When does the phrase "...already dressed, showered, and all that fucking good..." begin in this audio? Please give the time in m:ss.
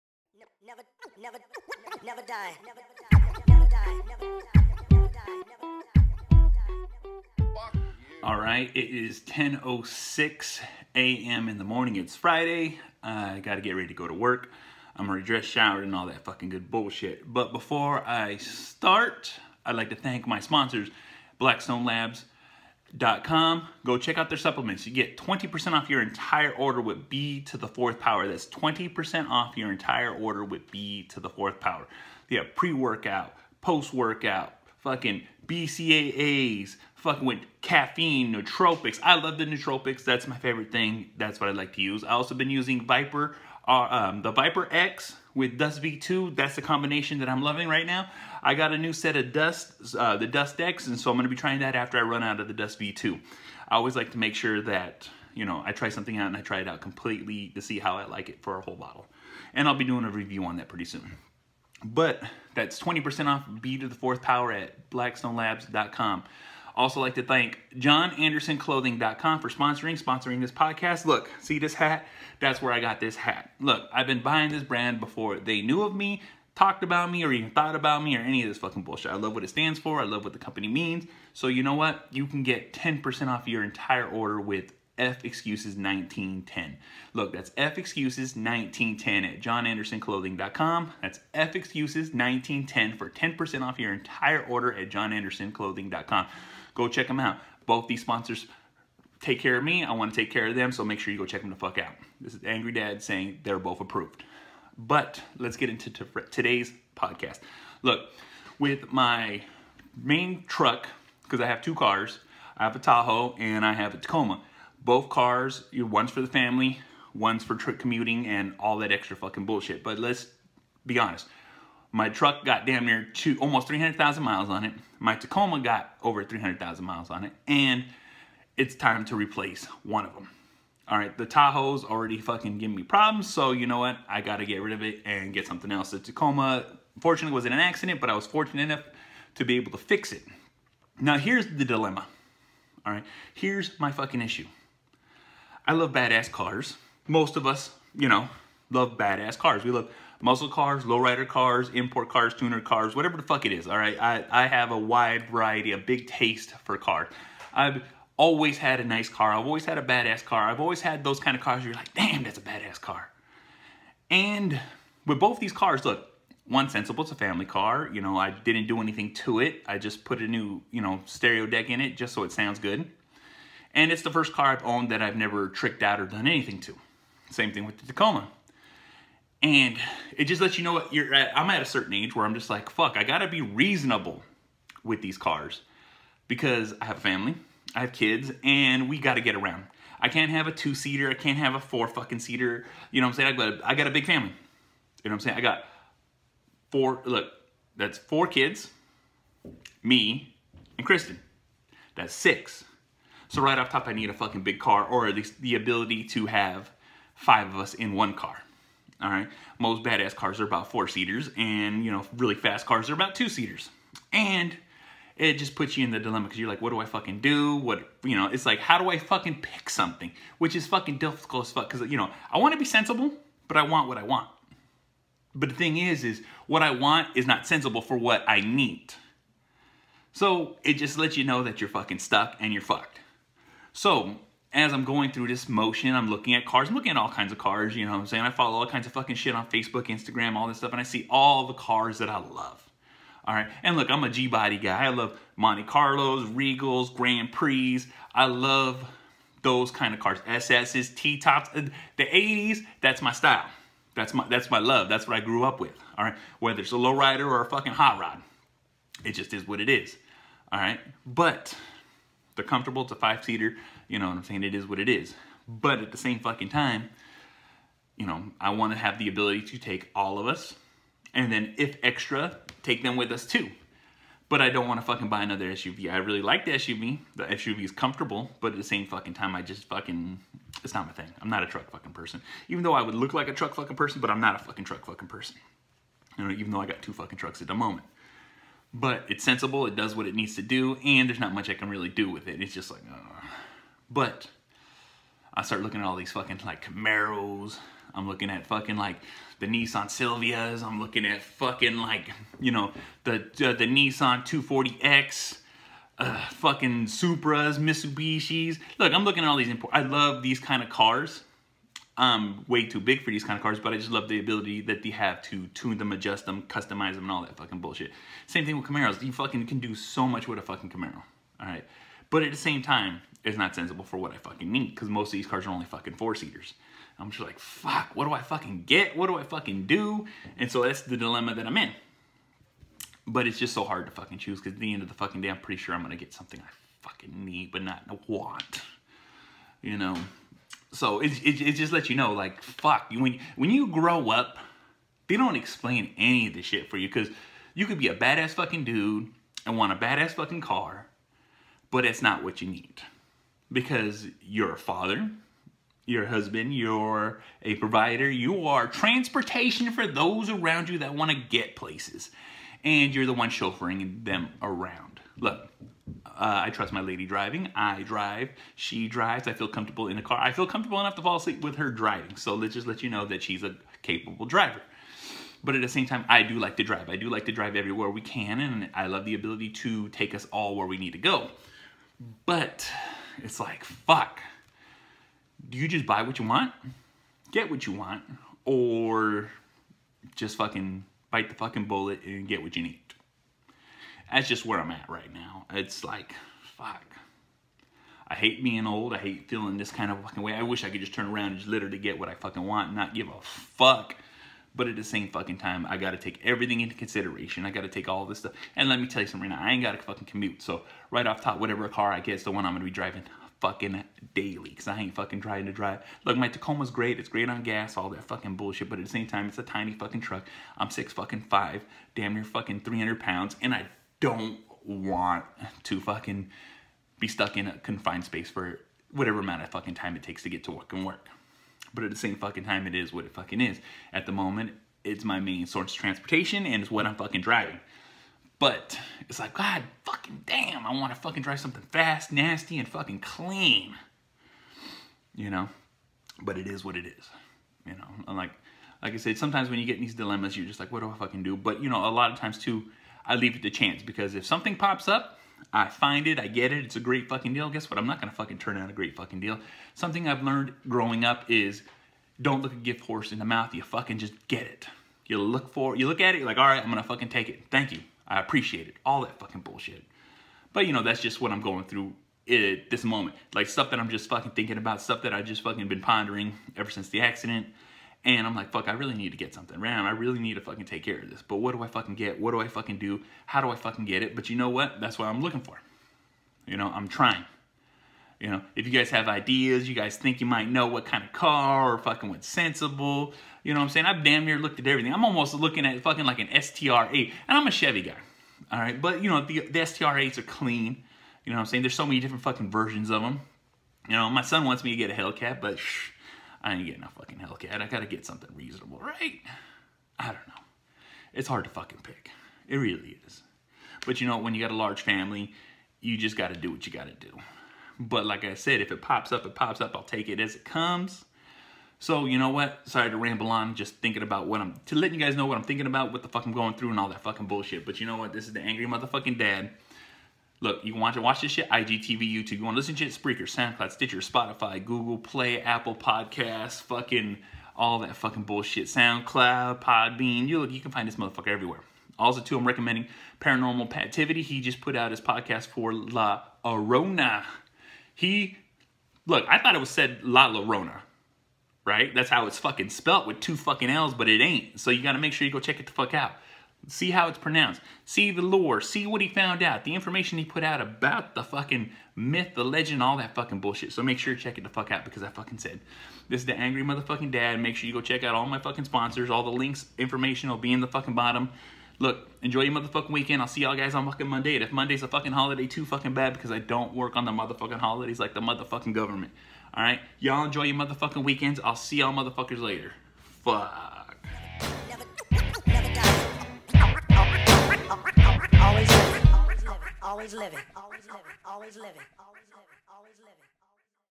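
0:15.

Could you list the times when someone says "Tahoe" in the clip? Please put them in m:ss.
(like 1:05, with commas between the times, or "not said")
1:52, 2:11.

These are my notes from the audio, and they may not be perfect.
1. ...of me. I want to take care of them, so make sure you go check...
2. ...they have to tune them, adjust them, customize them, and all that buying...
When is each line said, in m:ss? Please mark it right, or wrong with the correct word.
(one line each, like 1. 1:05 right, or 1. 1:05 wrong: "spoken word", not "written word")
1. 1:39 right
2. 5:14 wrong: "fucking", not "buying".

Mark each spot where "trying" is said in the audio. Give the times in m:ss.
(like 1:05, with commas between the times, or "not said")
0:51, 6:55, 8:06.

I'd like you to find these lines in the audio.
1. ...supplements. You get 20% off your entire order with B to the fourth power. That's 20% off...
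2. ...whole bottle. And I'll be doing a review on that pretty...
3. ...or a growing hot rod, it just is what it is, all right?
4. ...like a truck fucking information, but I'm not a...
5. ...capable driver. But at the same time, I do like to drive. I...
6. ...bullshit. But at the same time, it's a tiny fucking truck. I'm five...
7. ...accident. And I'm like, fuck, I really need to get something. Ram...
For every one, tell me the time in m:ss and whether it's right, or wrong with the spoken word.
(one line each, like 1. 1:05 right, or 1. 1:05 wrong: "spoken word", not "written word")
1. 0:24 right
2. 0:58 right
3. 4:17 wrong: "fucking", not "growing"
4. 4:43 wrong: "person", not "information"
5. 6:13 right
6. 6:58 wrong: "six", not "five"
7. 7:57 right.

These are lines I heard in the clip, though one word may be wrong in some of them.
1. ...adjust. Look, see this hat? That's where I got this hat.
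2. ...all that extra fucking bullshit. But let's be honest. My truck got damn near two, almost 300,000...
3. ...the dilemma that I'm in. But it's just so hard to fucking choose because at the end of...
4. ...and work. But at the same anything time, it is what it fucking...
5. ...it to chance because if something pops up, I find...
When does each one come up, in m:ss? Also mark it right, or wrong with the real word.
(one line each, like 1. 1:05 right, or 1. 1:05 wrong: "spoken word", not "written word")
1. 1:10 wrong: "podcast", not "adjust"
2. 1:58 right
3. 5:30 right
4. 7:10 wrong: "fucking", not "anything"
5. 7:33 right.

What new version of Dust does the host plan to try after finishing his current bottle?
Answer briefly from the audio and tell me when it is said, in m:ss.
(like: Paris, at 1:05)
Dust X, at 0:50.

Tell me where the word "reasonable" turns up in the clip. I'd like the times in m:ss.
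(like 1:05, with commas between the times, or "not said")
3:03, 8:28.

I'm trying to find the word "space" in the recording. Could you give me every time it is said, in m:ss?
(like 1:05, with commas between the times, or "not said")
7:08.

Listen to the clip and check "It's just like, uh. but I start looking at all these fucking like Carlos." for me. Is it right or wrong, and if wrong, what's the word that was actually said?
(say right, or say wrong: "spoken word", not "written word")
wrong: "Camaros", not "Carlos".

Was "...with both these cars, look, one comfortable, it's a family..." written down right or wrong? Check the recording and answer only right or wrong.
wrong.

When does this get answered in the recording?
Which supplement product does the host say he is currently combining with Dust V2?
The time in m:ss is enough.
0:44.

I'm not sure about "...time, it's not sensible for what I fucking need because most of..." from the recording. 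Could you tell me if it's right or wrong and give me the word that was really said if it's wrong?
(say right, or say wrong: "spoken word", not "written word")
right.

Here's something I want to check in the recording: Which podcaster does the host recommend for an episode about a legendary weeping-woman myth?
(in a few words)
Paranormal Pativity.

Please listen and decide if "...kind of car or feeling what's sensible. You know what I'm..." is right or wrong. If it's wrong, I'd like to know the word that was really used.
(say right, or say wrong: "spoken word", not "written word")
wrong: "fucking", not "feeling".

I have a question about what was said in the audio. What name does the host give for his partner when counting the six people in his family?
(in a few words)
Kristen.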